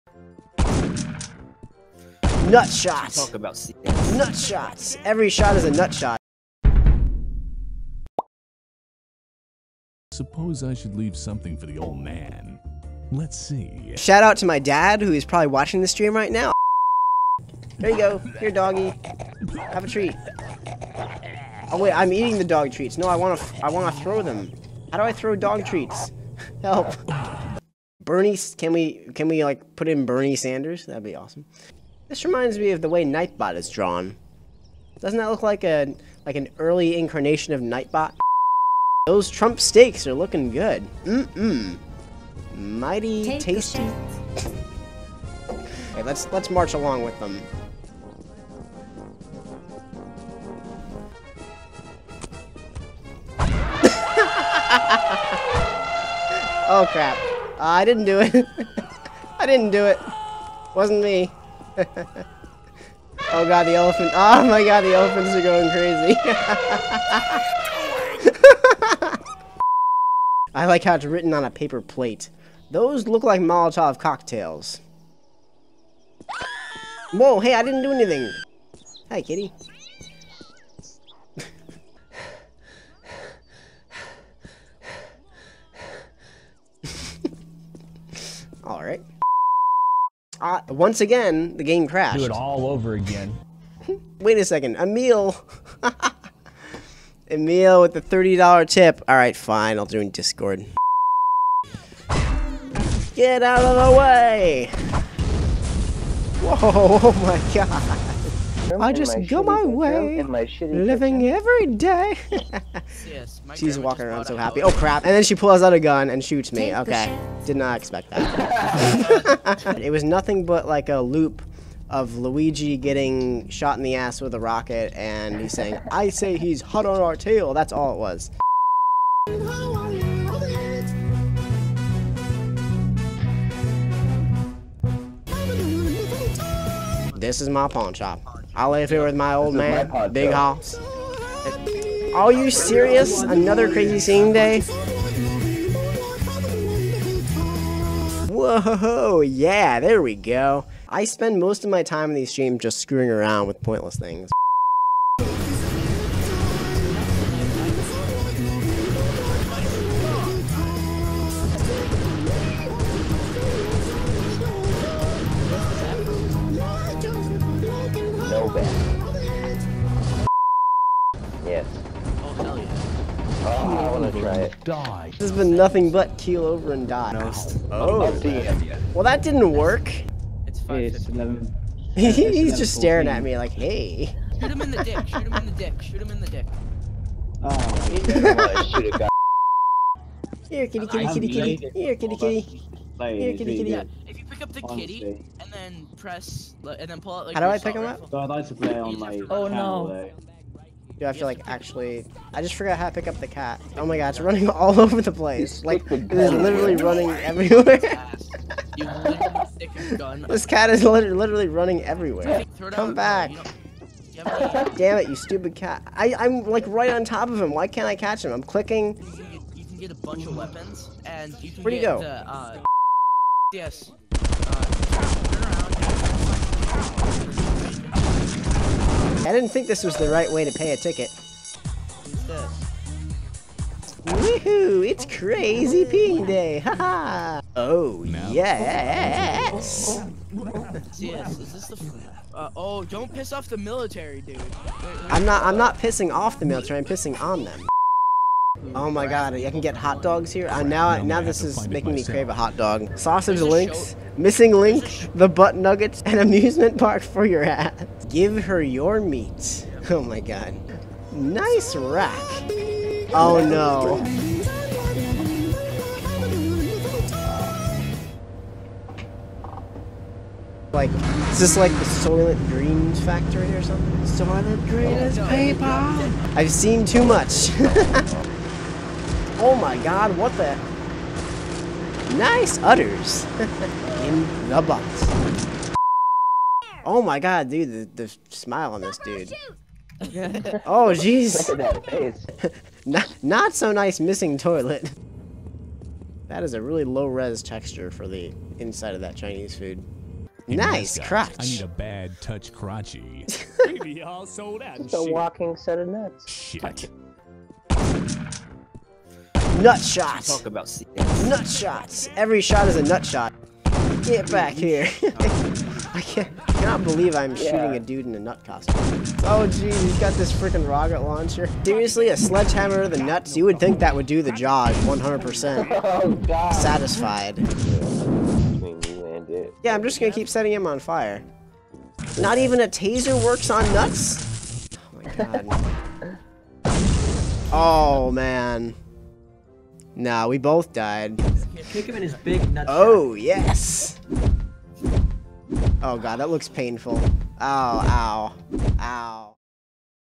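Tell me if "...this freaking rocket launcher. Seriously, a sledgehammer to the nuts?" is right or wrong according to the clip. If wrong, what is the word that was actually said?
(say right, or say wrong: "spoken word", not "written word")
right.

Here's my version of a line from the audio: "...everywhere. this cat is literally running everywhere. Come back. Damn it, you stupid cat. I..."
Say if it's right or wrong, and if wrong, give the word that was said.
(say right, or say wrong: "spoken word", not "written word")
right.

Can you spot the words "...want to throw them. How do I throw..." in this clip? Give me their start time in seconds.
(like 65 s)
23 s.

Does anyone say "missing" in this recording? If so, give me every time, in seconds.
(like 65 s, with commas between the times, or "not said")
254 s, 293 s.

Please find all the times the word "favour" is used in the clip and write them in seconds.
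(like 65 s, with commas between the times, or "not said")
not said.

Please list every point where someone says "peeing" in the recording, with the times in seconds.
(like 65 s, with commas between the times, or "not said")
235 s.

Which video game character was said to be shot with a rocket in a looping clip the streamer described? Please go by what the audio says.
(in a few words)
Luigi.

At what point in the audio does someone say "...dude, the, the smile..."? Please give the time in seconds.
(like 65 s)
287 s.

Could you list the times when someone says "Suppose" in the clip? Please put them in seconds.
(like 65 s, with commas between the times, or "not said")
10 s.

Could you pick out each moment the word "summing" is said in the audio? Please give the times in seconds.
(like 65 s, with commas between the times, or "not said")
not said.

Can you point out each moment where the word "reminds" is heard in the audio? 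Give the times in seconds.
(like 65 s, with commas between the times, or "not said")
32 s.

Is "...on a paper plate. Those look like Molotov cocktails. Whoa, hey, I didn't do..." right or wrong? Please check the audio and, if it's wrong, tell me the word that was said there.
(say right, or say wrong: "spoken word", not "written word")
right.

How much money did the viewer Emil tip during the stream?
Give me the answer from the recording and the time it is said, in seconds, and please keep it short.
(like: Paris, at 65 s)
$30, at 98 s.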